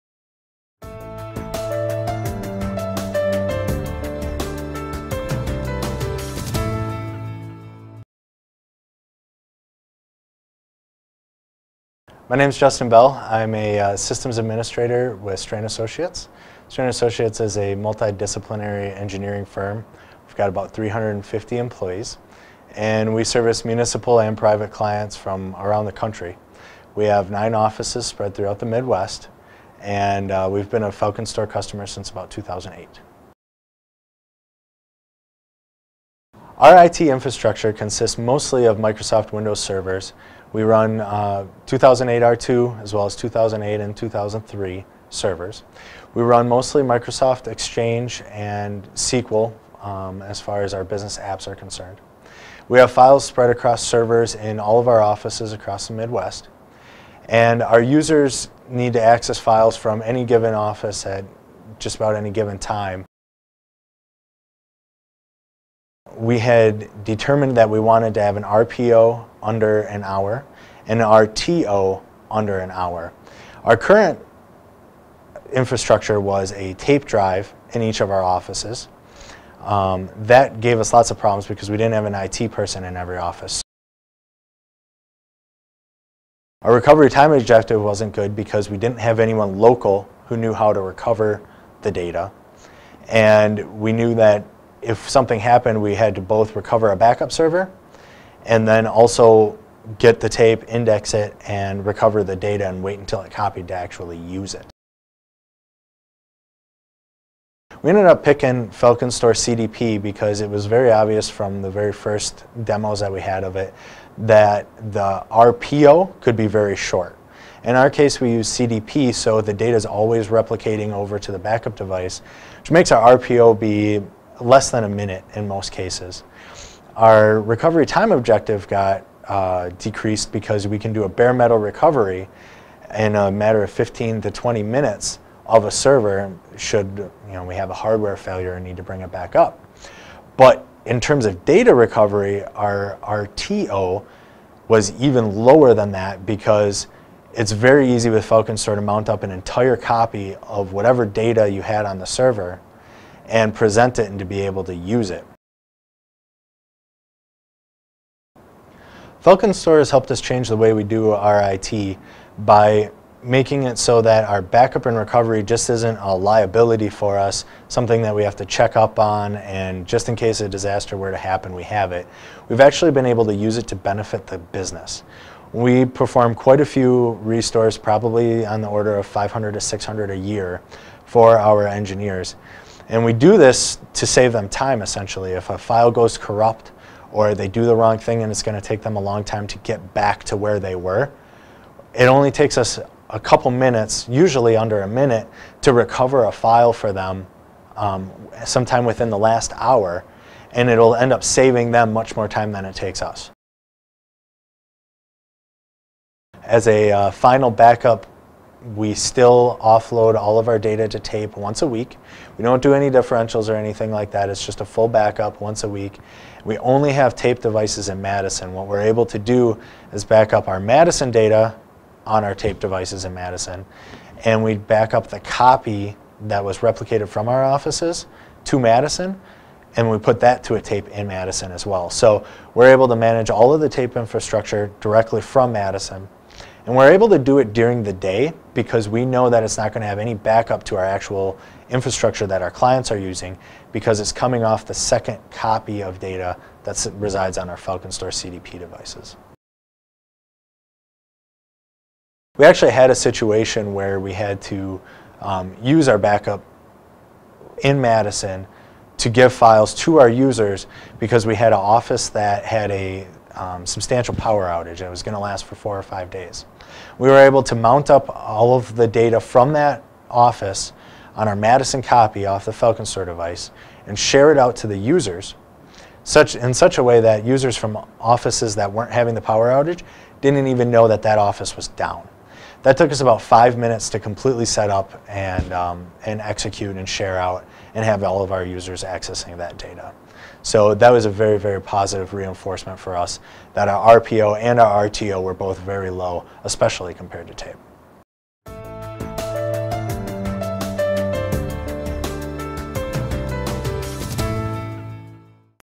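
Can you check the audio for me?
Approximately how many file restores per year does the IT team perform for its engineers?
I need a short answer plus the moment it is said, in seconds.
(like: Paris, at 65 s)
500 to 600, at 179 s.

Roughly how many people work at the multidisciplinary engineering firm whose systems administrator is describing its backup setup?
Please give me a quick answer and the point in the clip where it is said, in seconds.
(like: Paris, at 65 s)
350, at 20 s.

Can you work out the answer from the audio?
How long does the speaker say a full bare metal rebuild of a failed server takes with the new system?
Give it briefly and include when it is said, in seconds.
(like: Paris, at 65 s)
15 to 20 minutes, at 133 s.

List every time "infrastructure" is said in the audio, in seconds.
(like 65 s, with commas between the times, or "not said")
37 s, 75 s, 233 s, 241 s.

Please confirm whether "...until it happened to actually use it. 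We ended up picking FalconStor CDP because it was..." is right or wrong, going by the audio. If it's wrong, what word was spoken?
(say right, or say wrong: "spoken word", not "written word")
wrong: "copied", not "happened".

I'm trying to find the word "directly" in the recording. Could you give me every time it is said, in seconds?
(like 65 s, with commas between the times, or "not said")
234 s.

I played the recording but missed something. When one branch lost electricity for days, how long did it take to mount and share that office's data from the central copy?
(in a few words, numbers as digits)
about five minutes.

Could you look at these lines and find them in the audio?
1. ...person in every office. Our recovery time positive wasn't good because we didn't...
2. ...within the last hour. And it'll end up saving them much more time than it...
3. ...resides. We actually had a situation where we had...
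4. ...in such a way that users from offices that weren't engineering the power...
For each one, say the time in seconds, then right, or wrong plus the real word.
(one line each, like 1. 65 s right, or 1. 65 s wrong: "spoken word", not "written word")
1. 82 s wrong: "objective", not "positive"
2. 198 s right
3. 248 s wrong: "devices", not "resides"
4. 276 s wrong: "having", not "engineering".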